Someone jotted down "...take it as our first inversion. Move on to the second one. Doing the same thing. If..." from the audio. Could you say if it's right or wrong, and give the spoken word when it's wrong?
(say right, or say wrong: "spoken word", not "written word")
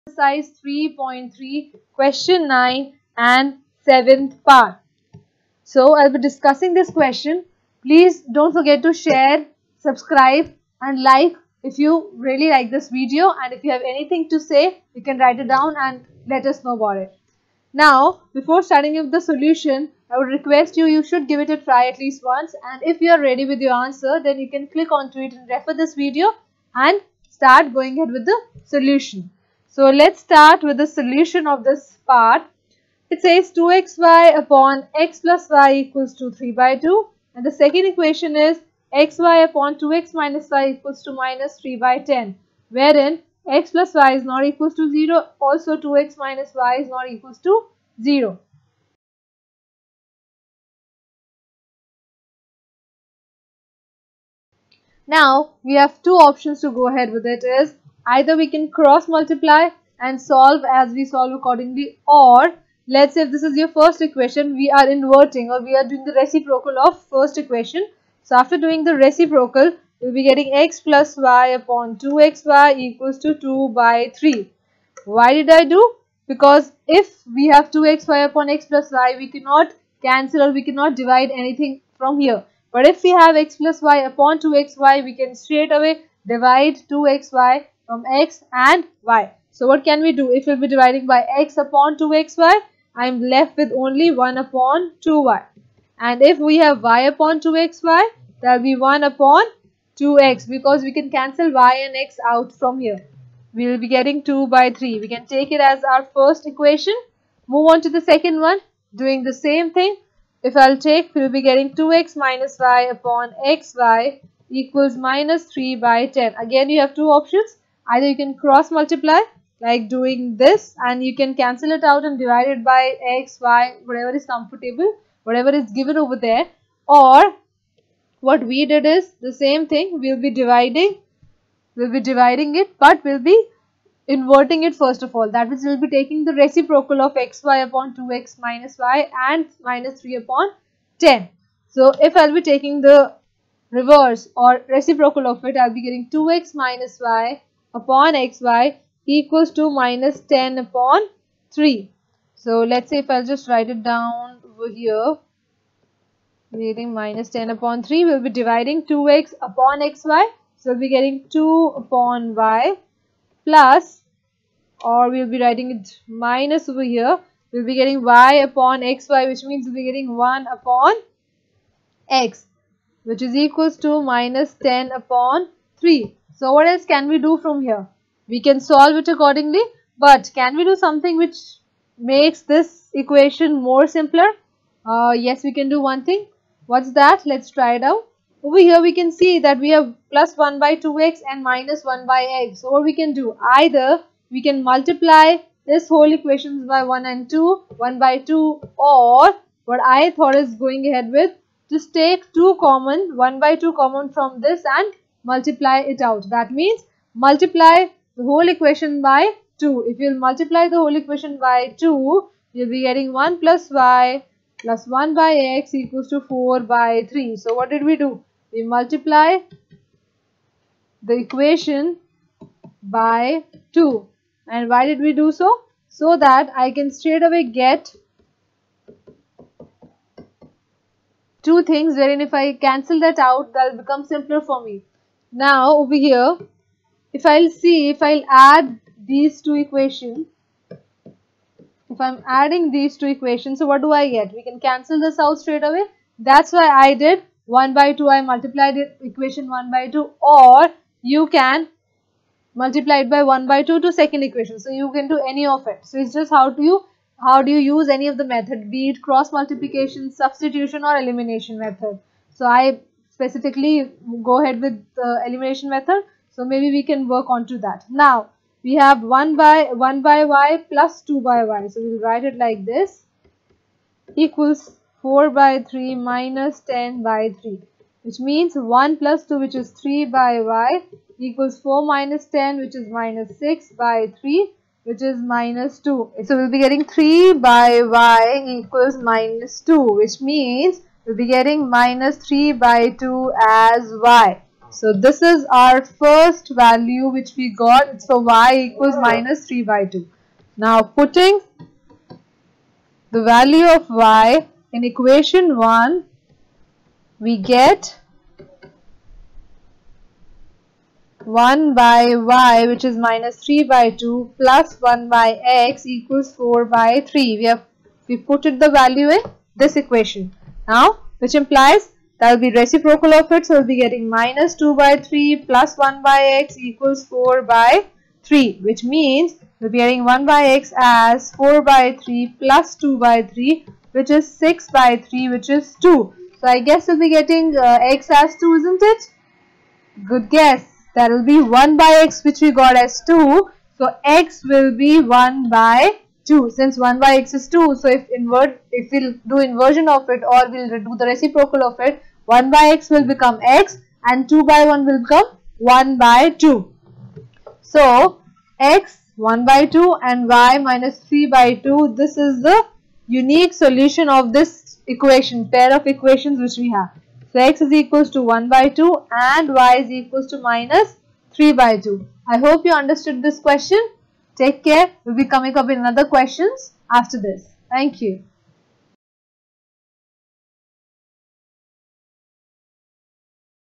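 wrong: "equation", not "inversion".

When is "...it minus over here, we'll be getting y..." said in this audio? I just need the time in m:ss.
2:45.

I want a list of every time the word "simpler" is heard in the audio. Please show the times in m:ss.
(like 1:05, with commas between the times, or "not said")
3:03, 3:54.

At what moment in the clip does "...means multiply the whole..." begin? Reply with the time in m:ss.
3:26.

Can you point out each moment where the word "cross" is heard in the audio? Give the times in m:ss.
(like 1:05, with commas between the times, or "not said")
0:58, 1:58, 4:19.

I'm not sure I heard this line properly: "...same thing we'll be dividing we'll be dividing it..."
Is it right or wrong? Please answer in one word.
right.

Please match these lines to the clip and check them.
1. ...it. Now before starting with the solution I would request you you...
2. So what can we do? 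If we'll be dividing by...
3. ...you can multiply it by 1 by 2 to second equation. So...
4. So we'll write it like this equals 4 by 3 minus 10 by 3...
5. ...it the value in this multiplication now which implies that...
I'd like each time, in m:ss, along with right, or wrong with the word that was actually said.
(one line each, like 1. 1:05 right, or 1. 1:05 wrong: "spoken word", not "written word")
1. 0:16 right
2. 1:29 right
3. 4:11 right
4. 4:31 right
5. 5:18 wrong: "equation", not "multiplication".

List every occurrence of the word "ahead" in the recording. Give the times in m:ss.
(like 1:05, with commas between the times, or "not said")
0:27, 0:56, 3:20, 4:24.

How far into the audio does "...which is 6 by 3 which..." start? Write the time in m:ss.
5:33.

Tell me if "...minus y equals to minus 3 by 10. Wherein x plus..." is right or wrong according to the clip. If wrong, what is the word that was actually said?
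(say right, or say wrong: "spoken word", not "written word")
right.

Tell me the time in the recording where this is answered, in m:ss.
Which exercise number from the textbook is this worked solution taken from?
0:00.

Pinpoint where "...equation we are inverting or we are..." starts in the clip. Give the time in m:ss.
1:04.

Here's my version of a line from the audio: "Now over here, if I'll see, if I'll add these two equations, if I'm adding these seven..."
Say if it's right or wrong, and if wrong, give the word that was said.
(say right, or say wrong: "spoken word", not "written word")
wrong: "two", not "seven".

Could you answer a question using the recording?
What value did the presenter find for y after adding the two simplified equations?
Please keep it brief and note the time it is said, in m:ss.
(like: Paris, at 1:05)
-3/2, at 4:51.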